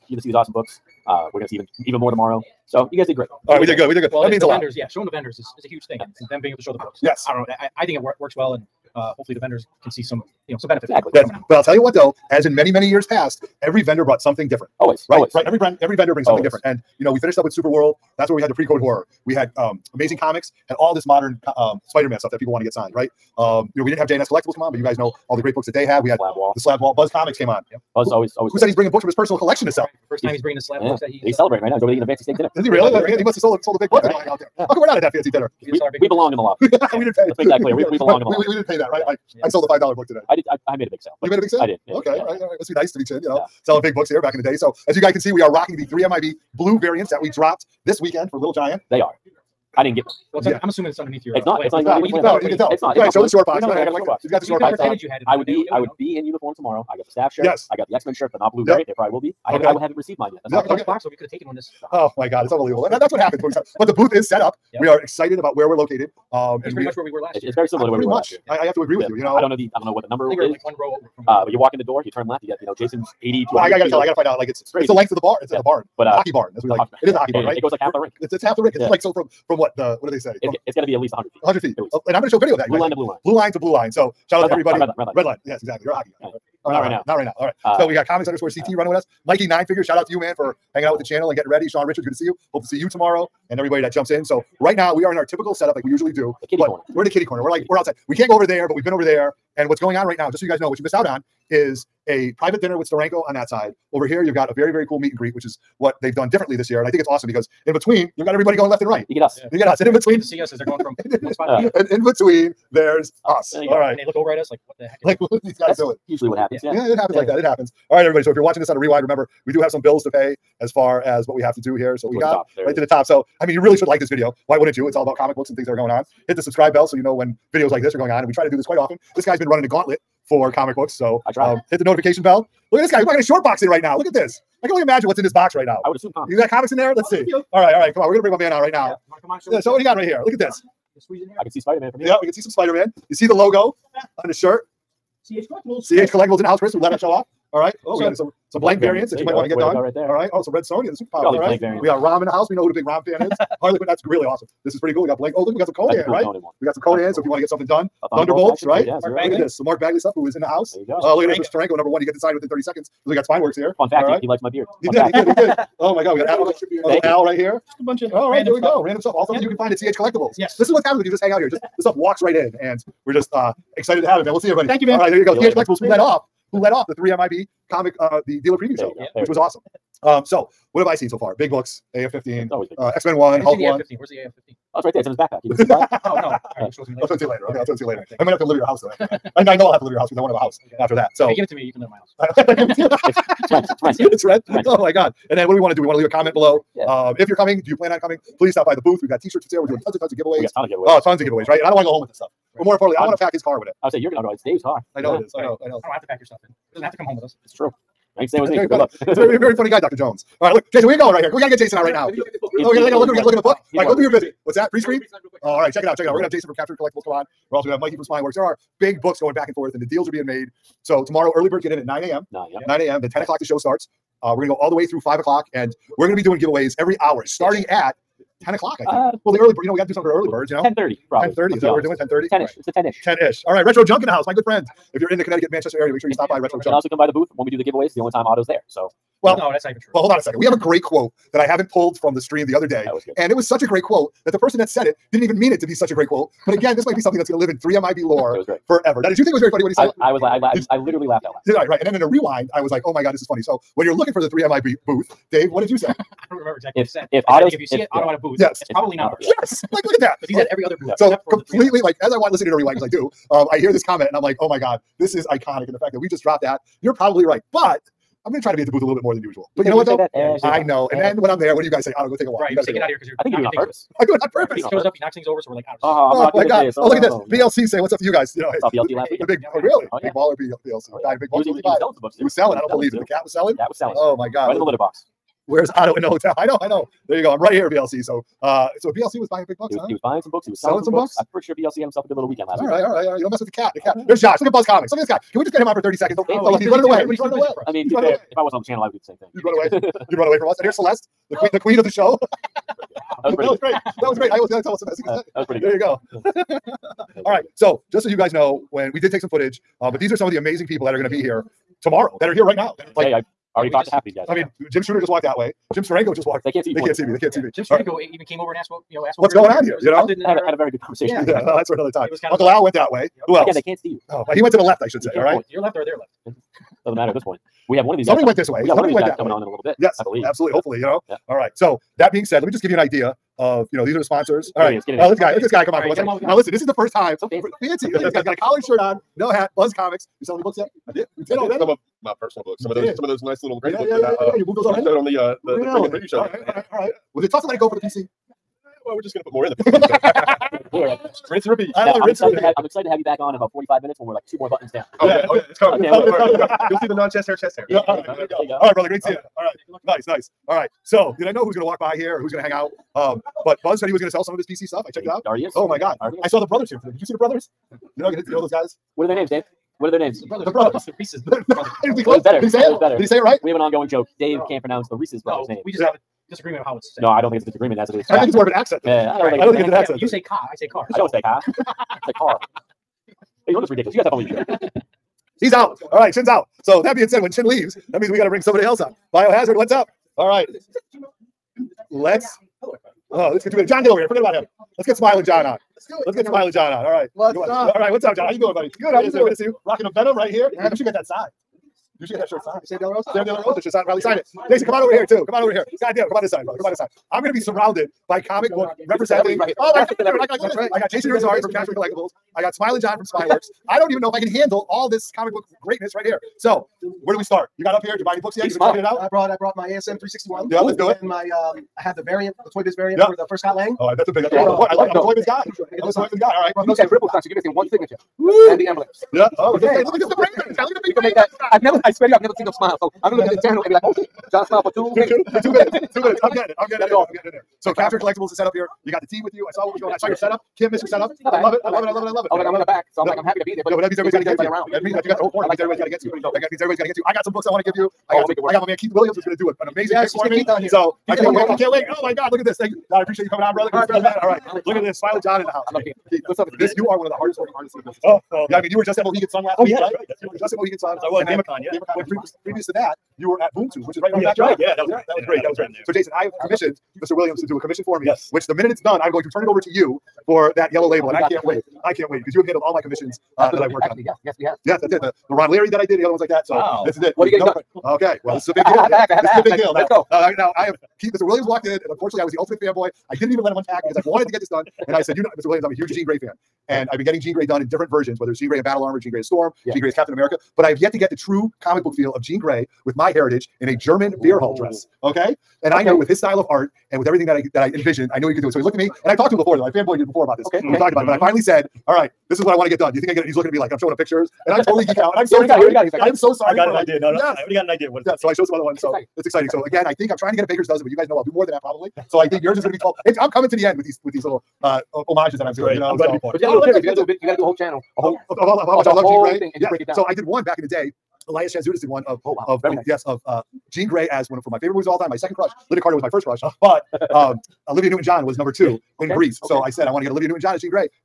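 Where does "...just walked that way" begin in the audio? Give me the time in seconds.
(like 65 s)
314 s.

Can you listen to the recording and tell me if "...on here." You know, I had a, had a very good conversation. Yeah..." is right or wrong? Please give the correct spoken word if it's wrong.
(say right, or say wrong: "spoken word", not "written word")
right.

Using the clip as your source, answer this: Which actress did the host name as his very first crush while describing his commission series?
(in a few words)
Lynda Carter.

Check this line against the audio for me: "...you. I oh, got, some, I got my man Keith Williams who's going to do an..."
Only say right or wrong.
right.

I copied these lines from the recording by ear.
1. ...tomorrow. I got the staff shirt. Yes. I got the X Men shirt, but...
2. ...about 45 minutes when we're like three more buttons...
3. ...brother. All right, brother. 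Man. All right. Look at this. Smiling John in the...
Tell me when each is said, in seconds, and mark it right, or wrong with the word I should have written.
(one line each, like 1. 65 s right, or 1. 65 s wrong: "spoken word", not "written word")
1. 56 s right
2. 353 s wrong: "two", not "three"
3. 453 s right.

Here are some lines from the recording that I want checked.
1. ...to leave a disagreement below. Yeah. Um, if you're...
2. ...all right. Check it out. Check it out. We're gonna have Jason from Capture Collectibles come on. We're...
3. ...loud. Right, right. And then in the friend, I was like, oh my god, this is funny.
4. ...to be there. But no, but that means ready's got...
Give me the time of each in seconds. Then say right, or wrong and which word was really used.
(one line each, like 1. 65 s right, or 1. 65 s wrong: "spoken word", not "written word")
1. 195 s wrong: "comment", not "disagreement"
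2. 215 s right
3. 251 s wrong: "rewind", not "friend"
4. 443 s wrong: "everybody", not "ready".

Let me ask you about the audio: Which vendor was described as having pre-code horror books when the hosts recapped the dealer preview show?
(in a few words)
Super World.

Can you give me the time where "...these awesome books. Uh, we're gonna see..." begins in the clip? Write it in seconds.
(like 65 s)
0 s.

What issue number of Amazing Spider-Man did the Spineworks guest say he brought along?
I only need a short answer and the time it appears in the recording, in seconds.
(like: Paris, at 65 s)
361, at 419 s.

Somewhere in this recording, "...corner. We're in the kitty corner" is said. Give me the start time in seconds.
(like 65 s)
96 s.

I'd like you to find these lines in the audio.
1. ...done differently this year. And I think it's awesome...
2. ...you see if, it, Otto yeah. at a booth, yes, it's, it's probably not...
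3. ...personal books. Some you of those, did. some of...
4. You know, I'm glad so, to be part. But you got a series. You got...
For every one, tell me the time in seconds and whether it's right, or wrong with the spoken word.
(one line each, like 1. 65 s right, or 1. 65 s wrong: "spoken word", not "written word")
1. 106 s right
2. 257 s right
3. 342 s right
4. 515 s right.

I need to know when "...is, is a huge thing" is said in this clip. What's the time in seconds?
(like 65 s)
5 s.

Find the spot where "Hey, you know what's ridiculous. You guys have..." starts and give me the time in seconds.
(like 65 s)
383 s.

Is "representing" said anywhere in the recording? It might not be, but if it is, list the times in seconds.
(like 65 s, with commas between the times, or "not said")
408 s.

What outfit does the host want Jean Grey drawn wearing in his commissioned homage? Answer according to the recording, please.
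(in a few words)
German beer hall dress.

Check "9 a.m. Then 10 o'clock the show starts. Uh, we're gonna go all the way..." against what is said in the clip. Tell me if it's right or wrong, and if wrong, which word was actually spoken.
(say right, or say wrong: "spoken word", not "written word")
right.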